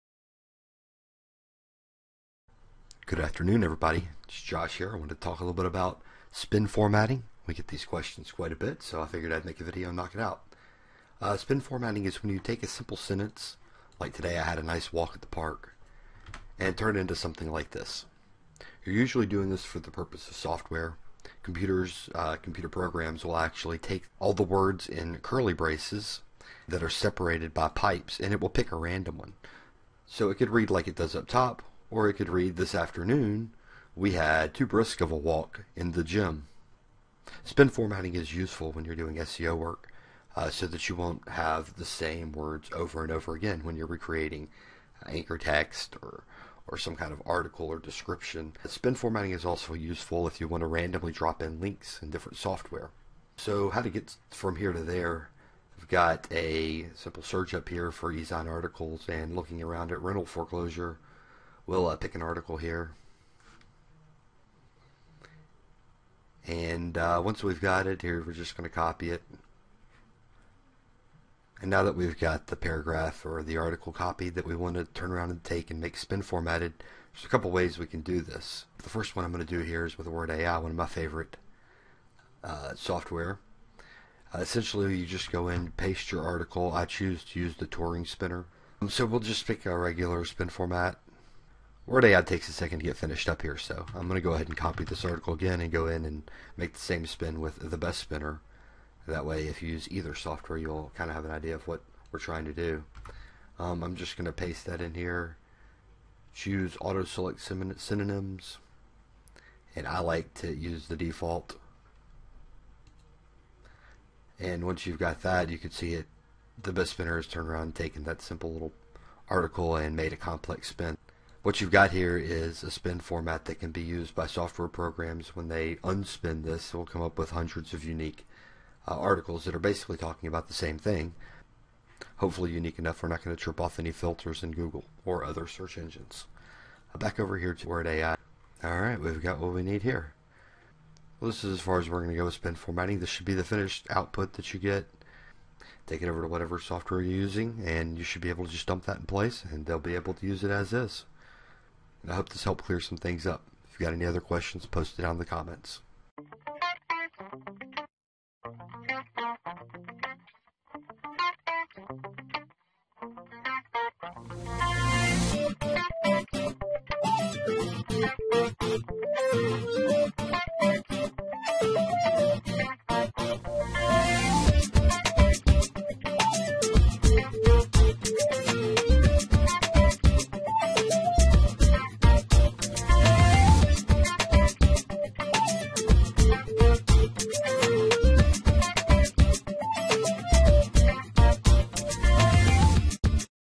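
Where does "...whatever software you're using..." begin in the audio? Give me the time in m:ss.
2:26.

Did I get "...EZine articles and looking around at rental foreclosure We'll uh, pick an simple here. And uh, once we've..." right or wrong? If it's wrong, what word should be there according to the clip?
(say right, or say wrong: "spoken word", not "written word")
wrong: "article", not "simple".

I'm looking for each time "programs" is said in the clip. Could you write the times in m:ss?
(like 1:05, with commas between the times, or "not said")
0:22, 2:04.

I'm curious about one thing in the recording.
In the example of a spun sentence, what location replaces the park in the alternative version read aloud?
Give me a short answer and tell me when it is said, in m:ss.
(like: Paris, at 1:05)
the gym, at 0:35.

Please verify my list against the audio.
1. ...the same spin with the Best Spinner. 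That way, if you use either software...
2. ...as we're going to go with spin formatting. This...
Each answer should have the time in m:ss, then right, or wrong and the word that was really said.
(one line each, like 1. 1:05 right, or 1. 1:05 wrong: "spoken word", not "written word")
1. 1:36 right
2. 2:21 right.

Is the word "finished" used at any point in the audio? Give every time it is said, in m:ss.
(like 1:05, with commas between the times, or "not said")
1:32, 2:23.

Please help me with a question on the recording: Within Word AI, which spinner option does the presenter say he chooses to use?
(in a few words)
Turing spinner.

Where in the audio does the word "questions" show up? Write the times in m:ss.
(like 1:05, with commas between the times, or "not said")
0:07, 2:34.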